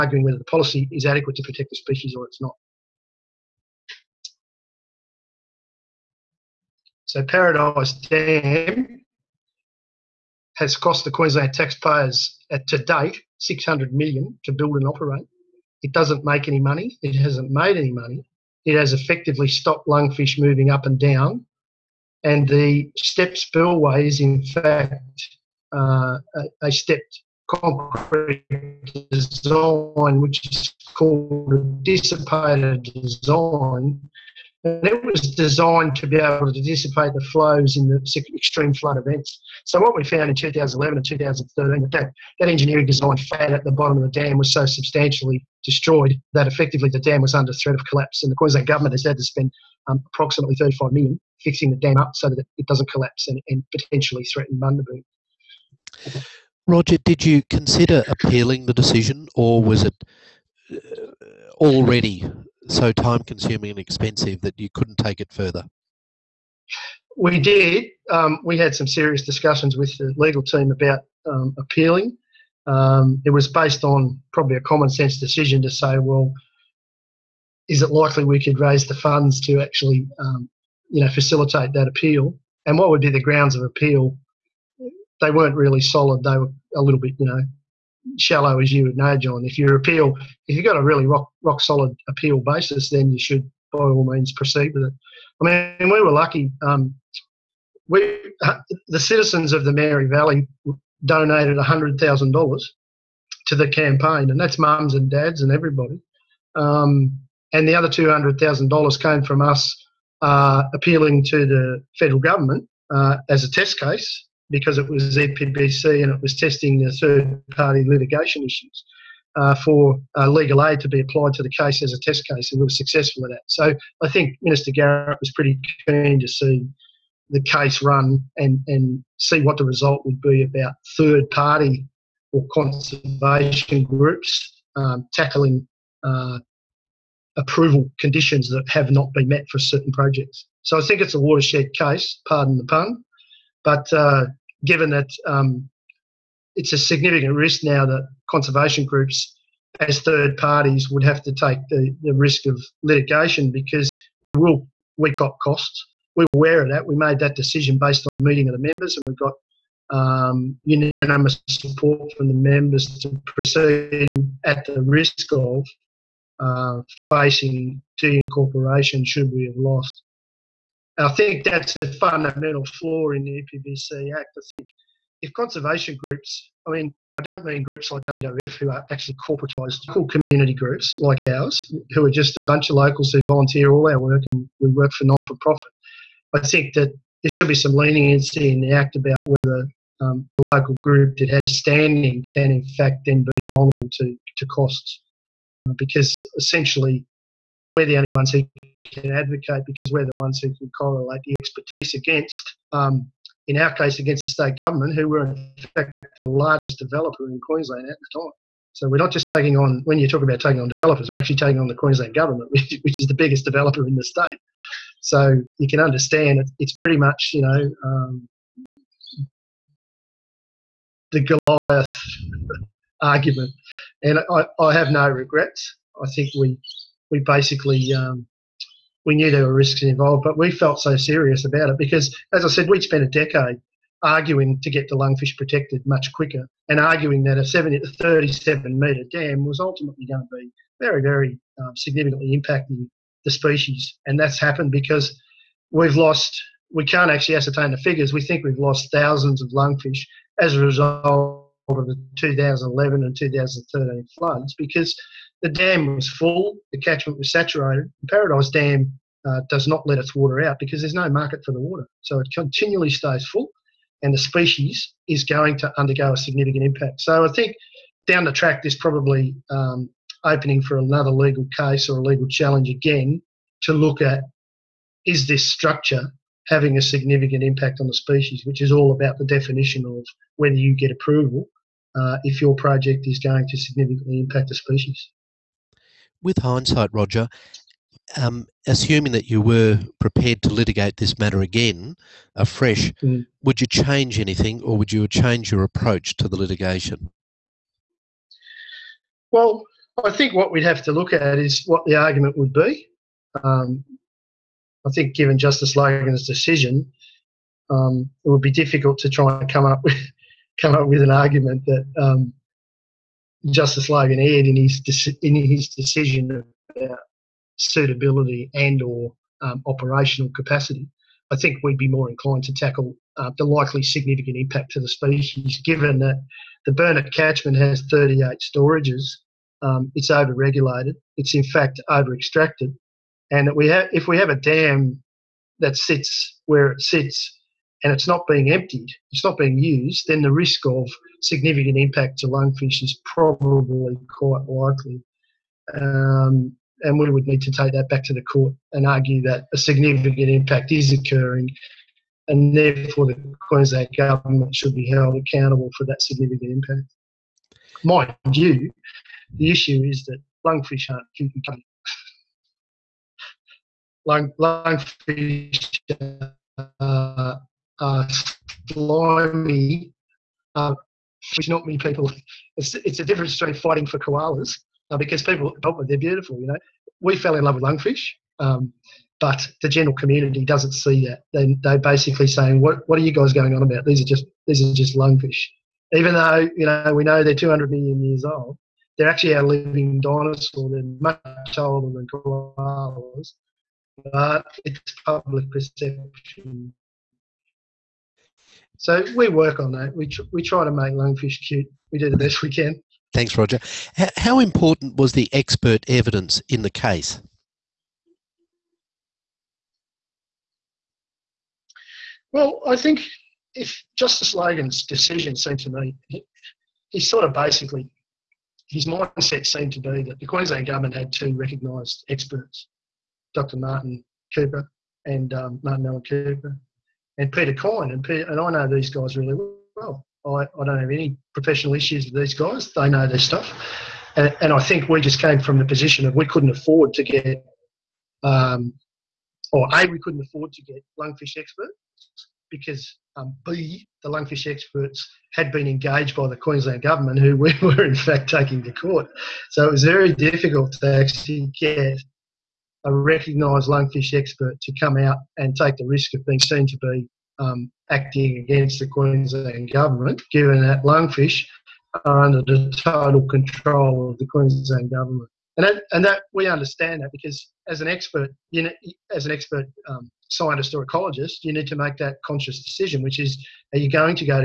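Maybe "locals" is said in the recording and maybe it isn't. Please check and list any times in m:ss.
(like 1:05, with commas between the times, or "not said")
3:02, 3:10.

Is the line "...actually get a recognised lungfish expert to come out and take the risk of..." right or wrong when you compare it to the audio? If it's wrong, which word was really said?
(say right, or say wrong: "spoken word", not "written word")
right.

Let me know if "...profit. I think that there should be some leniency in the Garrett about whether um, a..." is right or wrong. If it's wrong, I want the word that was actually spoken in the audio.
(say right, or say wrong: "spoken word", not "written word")
wrong: "Act", not "Garrett".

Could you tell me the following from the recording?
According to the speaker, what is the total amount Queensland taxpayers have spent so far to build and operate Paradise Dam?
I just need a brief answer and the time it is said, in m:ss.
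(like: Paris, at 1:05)
$600 million, at 0:13.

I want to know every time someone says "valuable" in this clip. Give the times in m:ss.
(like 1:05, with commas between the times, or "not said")
not said.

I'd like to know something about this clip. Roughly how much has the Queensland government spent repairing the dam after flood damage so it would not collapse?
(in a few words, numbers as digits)
$35 million.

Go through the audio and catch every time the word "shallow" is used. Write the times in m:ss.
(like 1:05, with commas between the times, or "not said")
1:28.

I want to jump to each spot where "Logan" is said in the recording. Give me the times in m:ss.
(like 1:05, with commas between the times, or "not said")
5:05, 5:13, 6:54.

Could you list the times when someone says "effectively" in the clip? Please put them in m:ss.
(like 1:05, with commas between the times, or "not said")
0:18, 0:46.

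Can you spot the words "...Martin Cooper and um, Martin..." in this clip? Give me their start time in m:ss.
7:03.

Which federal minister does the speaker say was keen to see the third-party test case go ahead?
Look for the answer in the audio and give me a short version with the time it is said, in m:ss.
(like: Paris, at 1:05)
Minister Garrett, at 2:04.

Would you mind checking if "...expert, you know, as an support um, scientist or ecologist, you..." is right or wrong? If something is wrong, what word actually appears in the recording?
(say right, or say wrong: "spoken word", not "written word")
wrong: "expert", not "support".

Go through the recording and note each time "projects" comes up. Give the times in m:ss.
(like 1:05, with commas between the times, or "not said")
2:19, 4:42.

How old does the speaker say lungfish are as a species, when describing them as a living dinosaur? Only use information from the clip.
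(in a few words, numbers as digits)
200 million years.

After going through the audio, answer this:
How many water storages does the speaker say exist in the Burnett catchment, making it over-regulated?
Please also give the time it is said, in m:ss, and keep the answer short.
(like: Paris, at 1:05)
38, at 5:27.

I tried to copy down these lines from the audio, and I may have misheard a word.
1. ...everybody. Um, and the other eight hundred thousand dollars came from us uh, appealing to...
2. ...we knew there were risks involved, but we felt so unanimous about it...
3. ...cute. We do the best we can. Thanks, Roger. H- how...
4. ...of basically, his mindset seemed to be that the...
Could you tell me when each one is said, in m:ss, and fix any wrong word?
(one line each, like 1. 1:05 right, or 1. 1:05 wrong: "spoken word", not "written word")
1. 1:45 wrong: "two", not "eight"
2. 3:49 wrong: "serious", not "unanimous"
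3. 6:41 right
4. 6:57 right.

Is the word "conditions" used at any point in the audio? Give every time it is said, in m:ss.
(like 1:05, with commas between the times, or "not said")
2:17.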